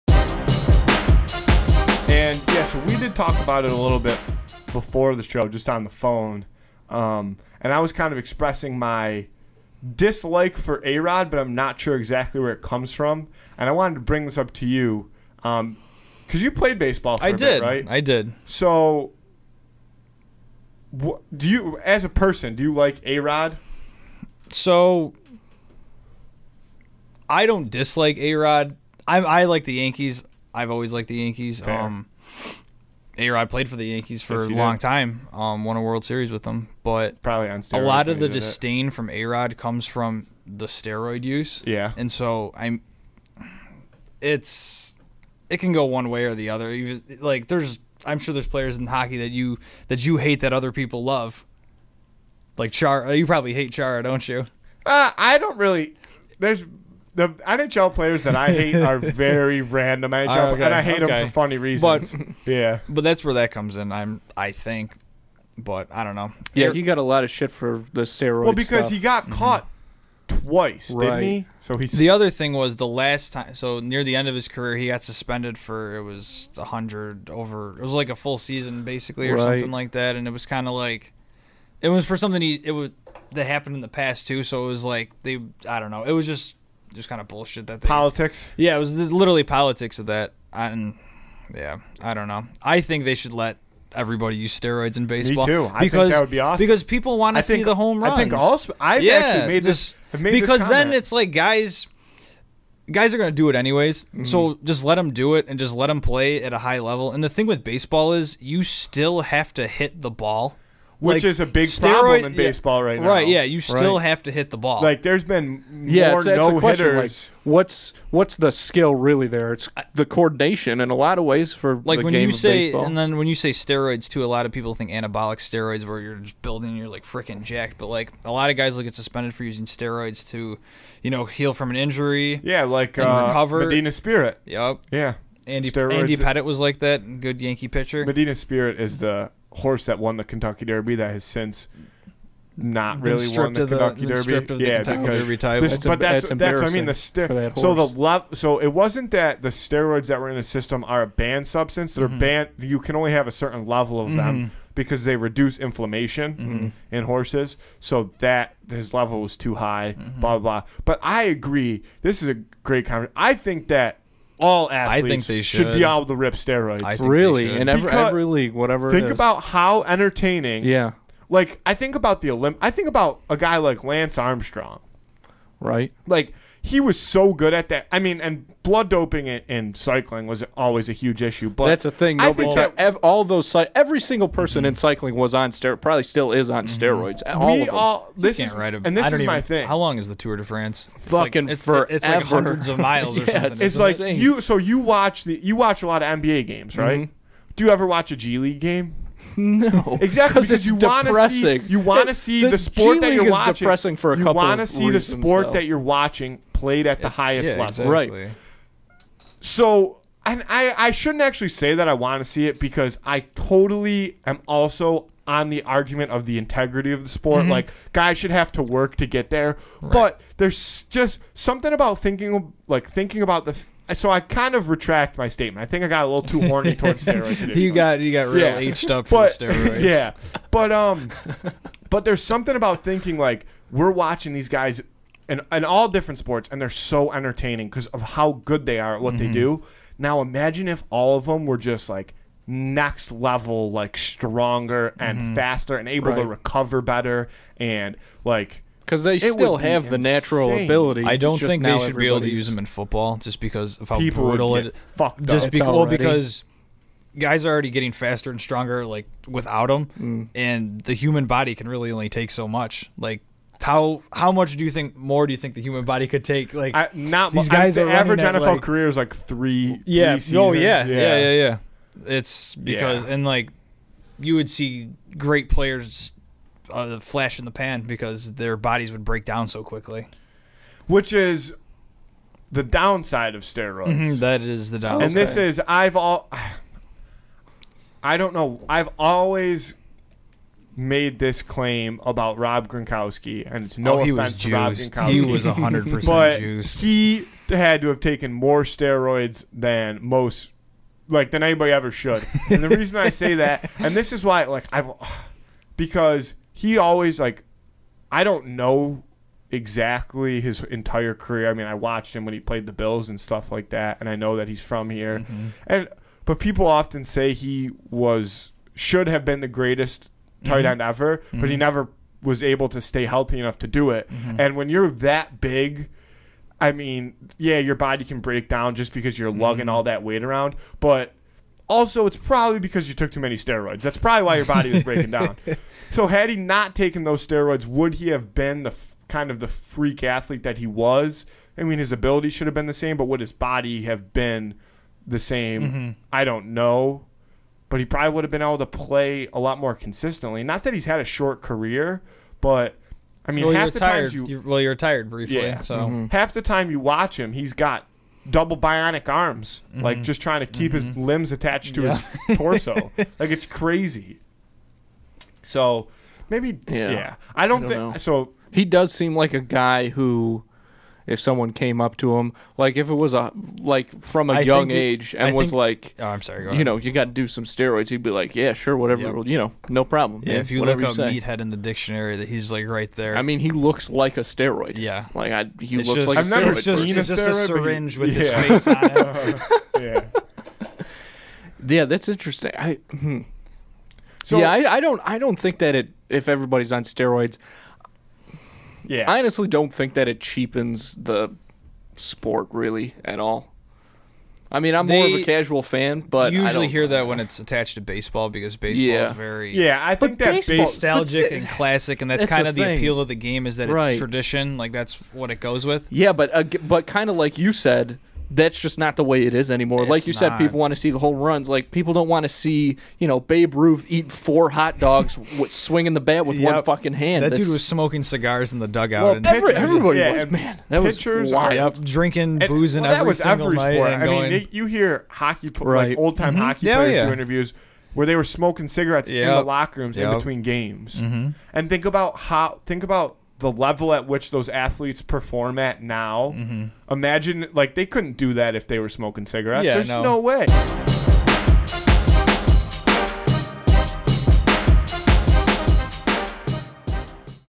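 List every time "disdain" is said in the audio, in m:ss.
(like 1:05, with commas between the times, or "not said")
0:38.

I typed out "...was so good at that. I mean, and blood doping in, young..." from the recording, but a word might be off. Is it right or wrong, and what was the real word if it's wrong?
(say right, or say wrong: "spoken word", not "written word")
wrong: "cycling", not "young".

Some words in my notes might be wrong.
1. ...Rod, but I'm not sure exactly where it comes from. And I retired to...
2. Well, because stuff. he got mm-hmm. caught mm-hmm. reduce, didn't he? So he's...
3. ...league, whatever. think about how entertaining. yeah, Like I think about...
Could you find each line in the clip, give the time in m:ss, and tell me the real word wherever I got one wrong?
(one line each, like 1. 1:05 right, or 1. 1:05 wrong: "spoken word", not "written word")
1. 0:10 wrong: "wanted", not "retired"
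2. 1:08 wrong: "twice", not "reduce"
3. 2:48 right.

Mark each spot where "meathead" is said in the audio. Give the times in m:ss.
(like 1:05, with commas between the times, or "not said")
6:21.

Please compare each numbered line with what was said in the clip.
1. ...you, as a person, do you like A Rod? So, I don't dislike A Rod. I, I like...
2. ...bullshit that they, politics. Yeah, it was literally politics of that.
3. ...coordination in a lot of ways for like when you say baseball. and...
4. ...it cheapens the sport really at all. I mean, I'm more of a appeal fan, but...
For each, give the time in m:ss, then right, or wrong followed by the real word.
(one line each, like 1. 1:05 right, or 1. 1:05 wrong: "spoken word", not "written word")
1. 0:21 right
2. 1:27 right
3. 2:00 right
4. 6:40 wrong: "casual", not "appeal".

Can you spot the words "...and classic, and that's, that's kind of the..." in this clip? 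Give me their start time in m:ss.
6:51.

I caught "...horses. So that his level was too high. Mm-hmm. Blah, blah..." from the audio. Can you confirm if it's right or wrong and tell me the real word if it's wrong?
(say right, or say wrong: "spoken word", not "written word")
right.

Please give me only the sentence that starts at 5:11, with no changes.
I mean, I watched him when he played the Bills and stuff like that, and I know that he's from here.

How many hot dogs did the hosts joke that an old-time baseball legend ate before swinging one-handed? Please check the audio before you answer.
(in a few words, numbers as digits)
4.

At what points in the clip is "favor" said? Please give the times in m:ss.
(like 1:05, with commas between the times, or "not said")
not said.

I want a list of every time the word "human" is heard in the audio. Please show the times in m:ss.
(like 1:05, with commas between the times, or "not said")
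4:20, 4:25.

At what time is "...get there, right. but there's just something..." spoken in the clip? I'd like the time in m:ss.
3:39.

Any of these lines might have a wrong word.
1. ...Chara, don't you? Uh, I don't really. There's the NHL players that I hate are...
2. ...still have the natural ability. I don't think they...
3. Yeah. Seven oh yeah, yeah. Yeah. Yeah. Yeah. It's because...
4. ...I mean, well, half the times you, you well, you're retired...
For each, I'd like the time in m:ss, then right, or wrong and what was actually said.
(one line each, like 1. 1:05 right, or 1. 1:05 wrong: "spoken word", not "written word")
1. 0:53 right
2. 4:09 right
3. 4:29 wrong: "Three", not "Seven"
4. 5:53 right.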